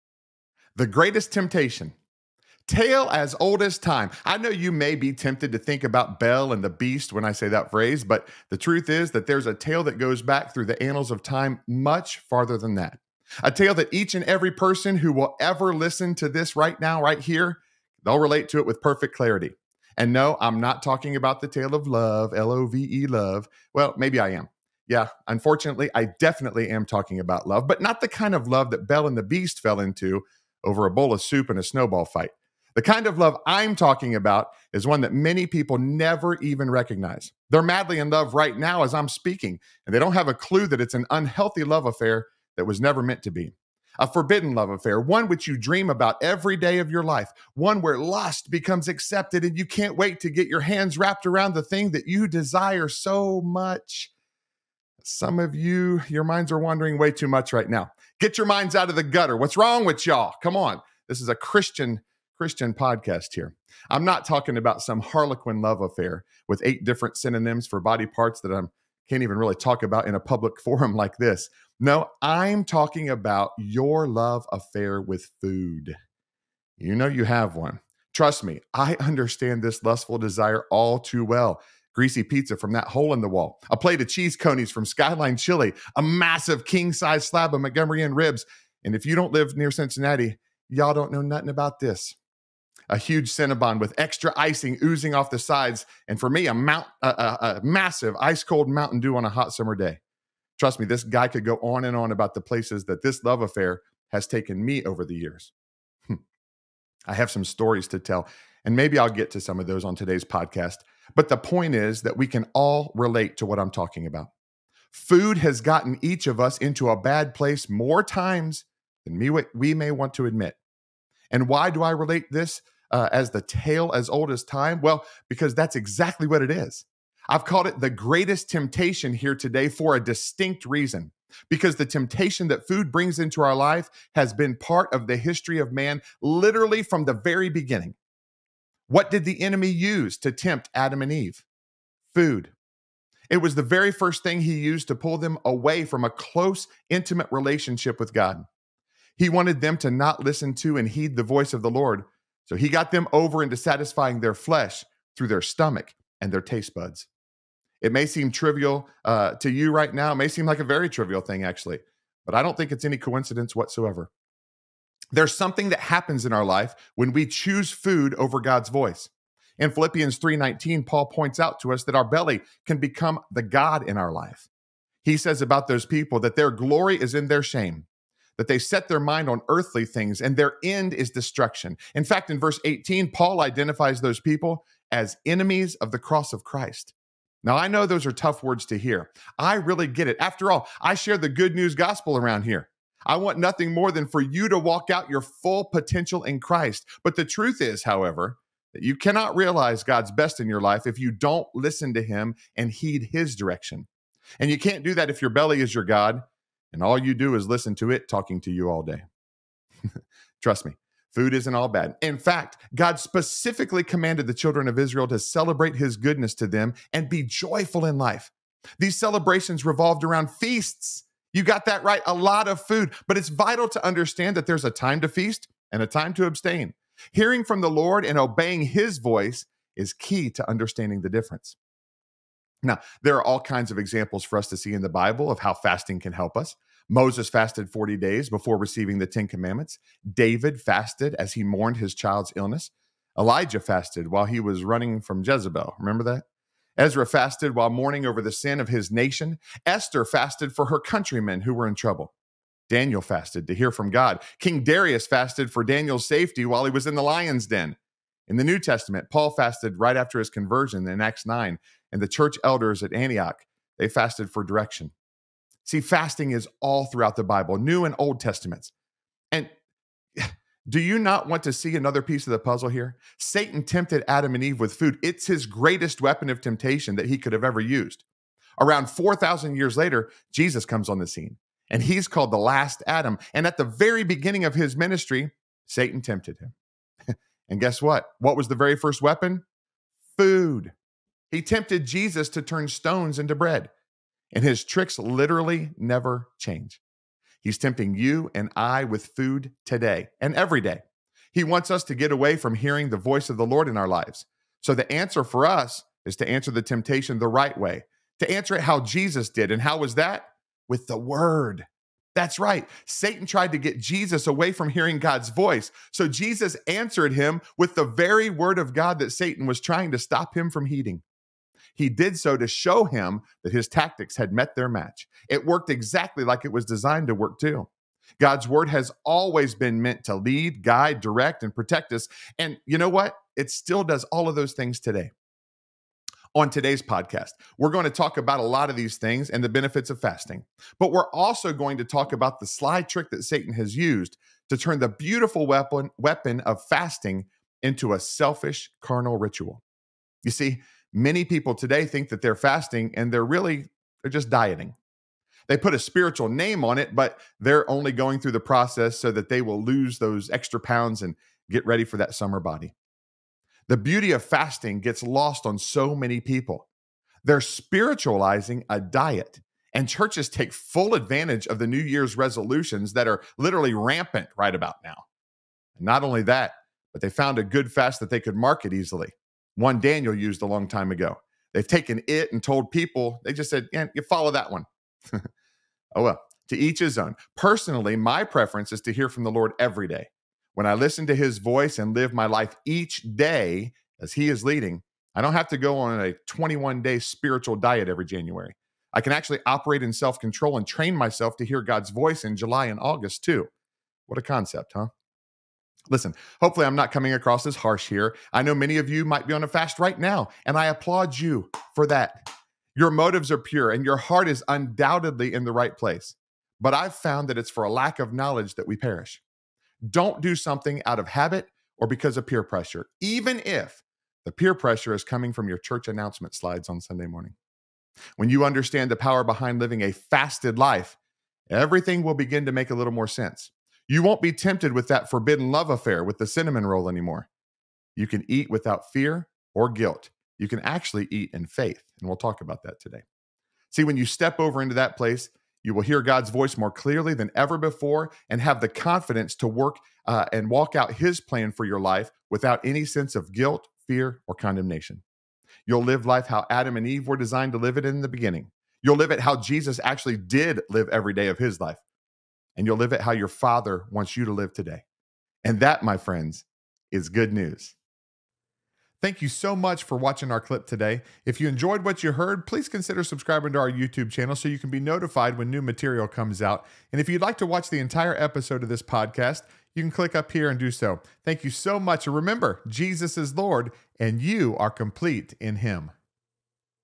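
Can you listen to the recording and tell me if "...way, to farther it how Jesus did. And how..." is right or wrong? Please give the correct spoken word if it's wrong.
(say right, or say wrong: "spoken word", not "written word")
wrong: "answer", not "farther".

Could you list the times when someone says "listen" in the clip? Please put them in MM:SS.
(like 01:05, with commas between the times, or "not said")
00:15, 02:30, 03:21, 03:27, 06:30, 06:45.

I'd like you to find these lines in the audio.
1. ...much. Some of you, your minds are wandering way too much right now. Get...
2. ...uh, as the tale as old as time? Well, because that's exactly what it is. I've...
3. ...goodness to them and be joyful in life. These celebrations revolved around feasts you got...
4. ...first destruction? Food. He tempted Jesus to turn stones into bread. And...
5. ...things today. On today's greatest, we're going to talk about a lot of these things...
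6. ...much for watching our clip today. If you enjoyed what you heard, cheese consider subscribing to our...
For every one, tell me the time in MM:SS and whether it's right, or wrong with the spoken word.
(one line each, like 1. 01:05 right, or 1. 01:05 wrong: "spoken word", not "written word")
1. 00:53 right
2. 02:02 right
3. 03:35 right
4. 04:48 wrong: "weapon", not "destruction"
5. 05:34 wrong: "podcast", not "greatest"
6. 07:49 wrong: "please", not "cheese".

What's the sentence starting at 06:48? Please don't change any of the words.
I know many of you might be on a fast right now, and I applaud you for that.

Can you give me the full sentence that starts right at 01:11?
No, I'm talking about your love affair with food.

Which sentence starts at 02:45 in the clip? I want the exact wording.
There's something that happens in our life when we choose food over God's voice.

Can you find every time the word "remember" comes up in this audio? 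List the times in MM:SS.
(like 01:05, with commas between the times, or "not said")
04:05, 08:02.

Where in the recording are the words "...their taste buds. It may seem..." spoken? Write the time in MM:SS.
02:36.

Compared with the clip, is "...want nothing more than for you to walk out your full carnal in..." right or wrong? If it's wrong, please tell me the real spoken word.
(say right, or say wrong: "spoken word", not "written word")
wrong: "potential", not "carnal".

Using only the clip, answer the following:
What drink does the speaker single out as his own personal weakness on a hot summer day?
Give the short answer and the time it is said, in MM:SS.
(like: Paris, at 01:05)
Mountain Dew, at 01:38.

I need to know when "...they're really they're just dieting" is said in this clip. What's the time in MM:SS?
05:53.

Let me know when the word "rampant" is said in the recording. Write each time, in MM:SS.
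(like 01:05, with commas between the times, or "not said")
06:13.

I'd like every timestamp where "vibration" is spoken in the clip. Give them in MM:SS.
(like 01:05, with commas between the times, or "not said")
not said.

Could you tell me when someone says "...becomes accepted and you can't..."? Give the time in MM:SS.
00:48.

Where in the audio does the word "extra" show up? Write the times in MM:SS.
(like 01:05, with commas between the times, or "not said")
01:33, 06:00.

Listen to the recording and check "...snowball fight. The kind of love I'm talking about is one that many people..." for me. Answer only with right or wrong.
right.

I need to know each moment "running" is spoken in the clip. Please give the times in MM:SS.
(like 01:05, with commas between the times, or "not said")
04:04.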